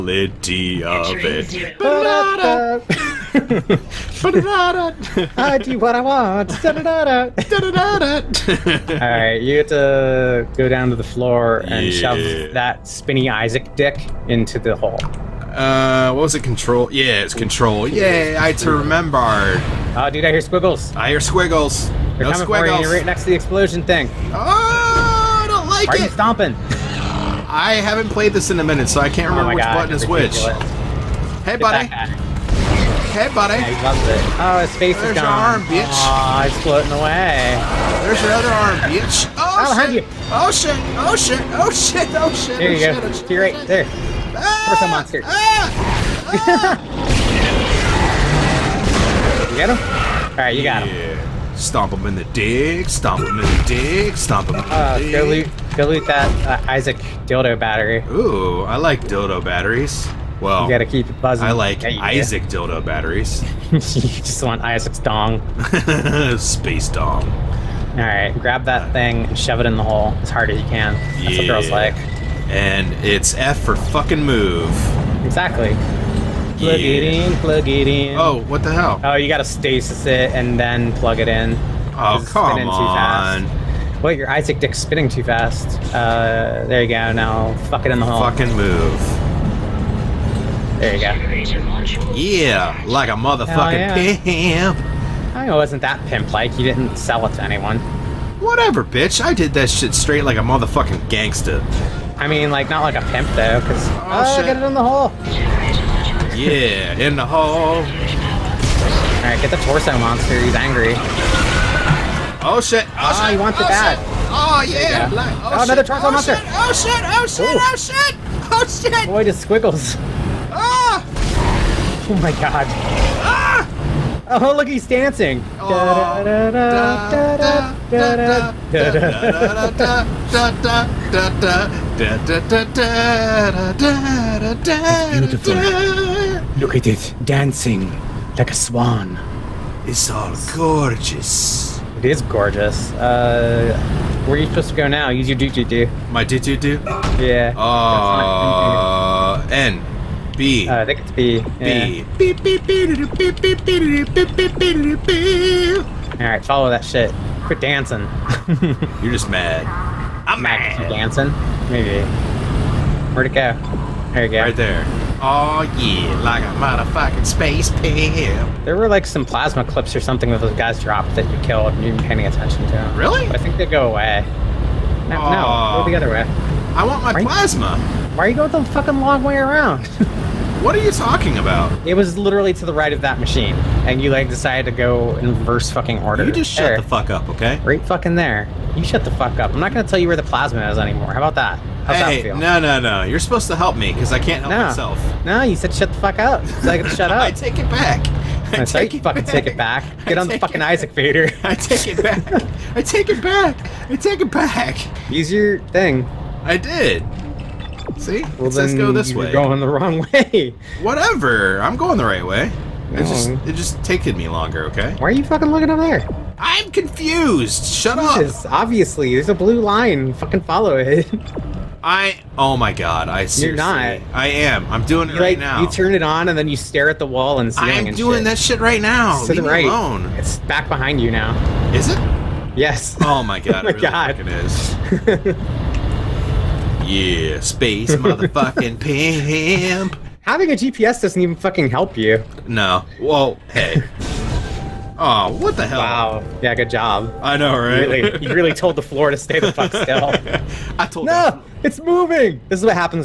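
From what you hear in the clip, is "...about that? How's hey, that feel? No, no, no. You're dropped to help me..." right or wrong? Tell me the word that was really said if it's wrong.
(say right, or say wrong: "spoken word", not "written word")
wrong: "supposed", not "dropped".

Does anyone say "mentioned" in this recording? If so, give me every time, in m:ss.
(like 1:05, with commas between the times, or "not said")
not said.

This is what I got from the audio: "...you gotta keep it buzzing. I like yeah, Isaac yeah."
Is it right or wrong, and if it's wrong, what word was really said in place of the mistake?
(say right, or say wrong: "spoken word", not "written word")
right.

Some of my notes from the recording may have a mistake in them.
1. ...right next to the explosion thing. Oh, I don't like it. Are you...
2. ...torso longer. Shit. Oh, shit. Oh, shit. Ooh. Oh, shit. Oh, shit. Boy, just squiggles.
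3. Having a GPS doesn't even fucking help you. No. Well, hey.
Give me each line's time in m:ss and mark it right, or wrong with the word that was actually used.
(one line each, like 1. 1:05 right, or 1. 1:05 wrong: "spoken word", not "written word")
1. 0:22 right
2. 1:55 wrong: "monster", not "longer"
3. 4:00 right.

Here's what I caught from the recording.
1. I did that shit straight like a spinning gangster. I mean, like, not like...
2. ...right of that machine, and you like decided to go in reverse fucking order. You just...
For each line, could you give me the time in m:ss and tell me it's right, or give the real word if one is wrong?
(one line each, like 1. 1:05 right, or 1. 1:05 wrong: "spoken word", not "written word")
1. 1:39 wrong: "motherfucking", not "spinning"
2. 3:02 right.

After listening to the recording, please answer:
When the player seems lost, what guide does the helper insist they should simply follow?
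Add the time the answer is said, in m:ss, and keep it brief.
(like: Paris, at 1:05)
blue line, at 3:39.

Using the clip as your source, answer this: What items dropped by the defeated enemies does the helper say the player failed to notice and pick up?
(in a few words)
plasma clips.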